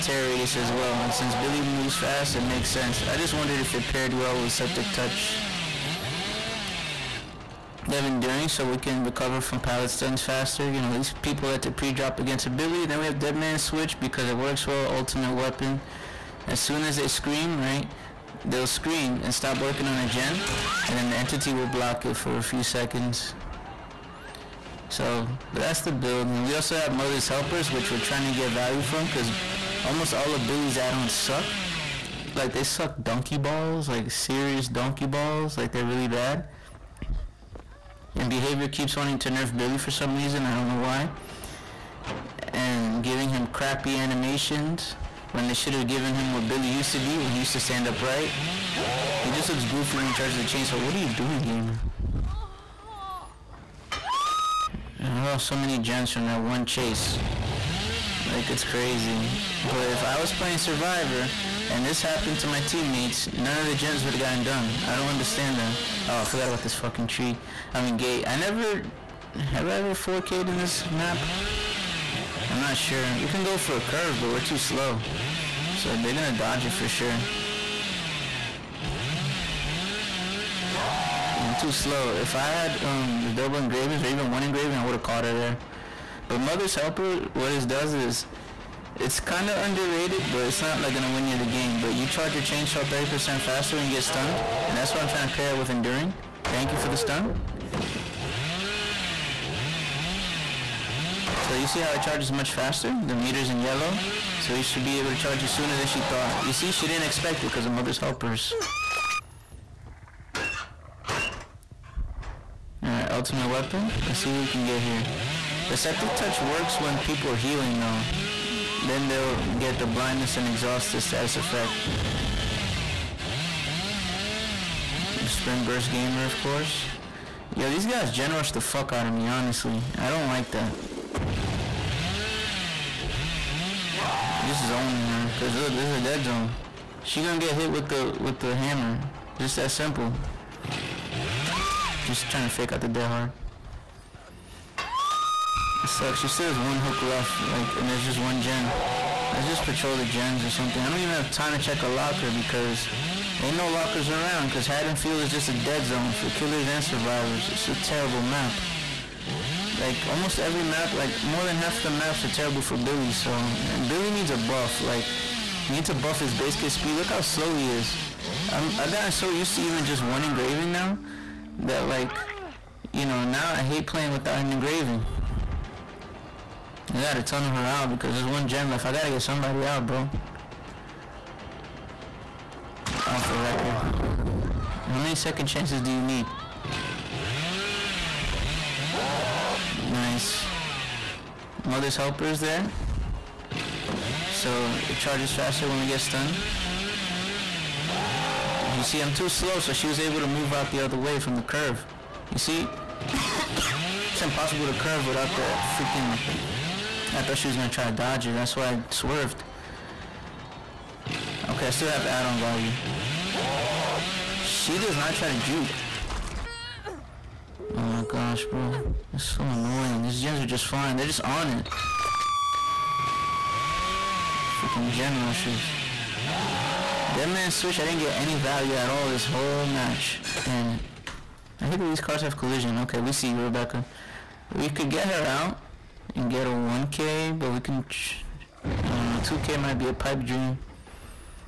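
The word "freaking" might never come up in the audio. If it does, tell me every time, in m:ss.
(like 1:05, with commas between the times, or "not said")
3:25, 3:44.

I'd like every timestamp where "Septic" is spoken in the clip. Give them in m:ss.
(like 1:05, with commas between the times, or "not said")
0:04, 1:55.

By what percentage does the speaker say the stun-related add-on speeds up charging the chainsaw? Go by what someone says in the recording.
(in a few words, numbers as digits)
30%.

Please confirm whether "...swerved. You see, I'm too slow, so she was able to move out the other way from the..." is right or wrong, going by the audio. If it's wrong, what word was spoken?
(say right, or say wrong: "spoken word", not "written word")
wrong: "stunned", not "swerved".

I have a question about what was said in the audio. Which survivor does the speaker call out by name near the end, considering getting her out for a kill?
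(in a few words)
Rebecca.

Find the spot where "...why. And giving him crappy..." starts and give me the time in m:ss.
0:40.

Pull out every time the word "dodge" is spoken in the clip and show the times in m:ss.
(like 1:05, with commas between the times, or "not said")
1:16, 3:27.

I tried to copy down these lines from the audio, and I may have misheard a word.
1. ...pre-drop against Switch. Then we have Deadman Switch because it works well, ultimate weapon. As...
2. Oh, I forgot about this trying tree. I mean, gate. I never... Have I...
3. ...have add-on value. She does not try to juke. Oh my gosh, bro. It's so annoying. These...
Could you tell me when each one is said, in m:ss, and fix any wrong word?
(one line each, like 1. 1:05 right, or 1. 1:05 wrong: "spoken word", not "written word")
1. 0:11 wrong: "Billy", not "Switch"
2. 1:06 wrong: "fucking", not "trying"
3. 3:31 right.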